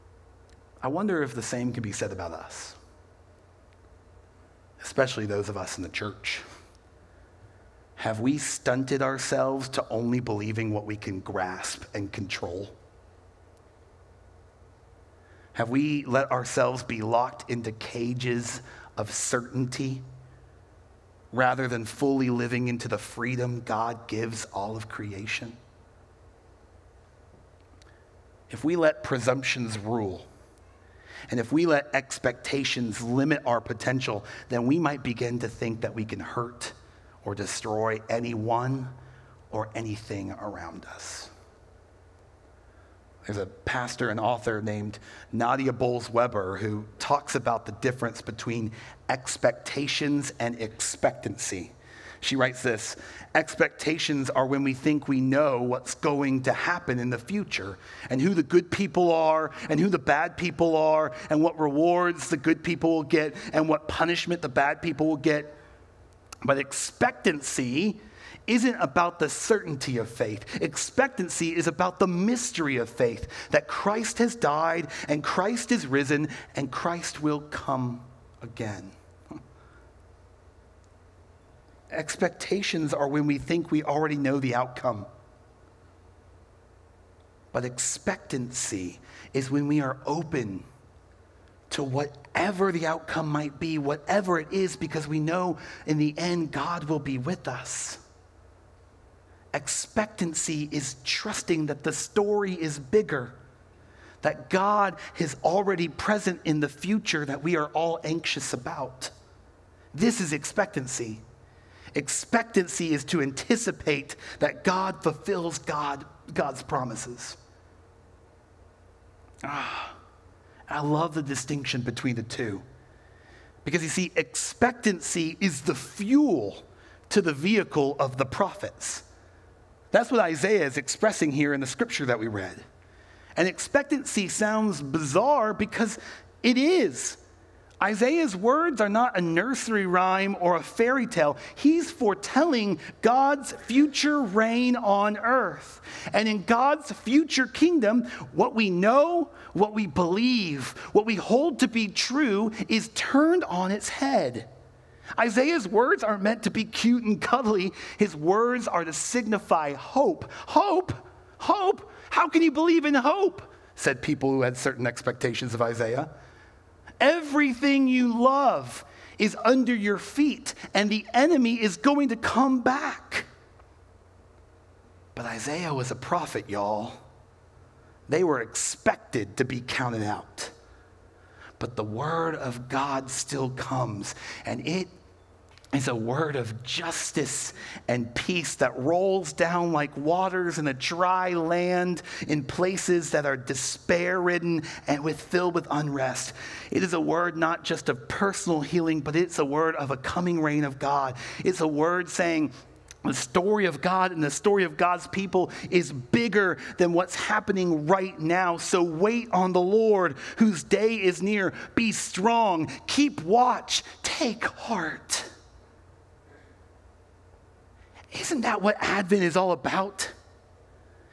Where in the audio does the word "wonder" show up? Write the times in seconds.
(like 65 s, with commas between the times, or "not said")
0 s.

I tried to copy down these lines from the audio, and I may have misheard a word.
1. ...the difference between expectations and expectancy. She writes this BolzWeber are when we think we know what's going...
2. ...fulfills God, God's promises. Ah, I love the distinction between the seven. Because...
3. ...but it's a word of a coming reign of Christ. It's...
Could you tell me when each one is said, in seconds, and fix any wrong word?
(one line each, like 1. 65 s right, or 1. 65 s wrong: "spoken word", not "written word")
1. 47 s wrong: "Expectations", not "BolzWeber"
2. 115 s wrong: "two", not "seven"
3. 198 s wrong: "God", not "Christ".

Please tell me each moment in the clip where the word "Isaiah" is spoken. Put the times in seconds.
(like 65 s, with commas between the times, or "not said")
130 s, 137 s, 155 s, 165 s, 175 s.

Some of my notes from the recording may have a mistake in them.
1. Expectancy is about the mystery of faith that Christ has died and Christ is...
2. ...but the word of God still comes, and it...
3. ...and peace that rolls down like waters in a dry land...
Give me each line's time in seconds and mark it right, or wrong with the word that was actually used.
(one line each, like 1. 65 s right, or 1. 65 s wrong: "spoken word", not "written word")
1. 70 s right
2. 181 s right
3. 187 s right.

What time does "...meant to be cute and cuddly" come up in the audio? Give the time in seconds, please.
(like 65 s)
156 s.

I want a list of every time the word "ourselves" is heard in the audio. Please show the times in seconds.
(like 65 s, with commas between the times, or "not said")
9 s, 16 s.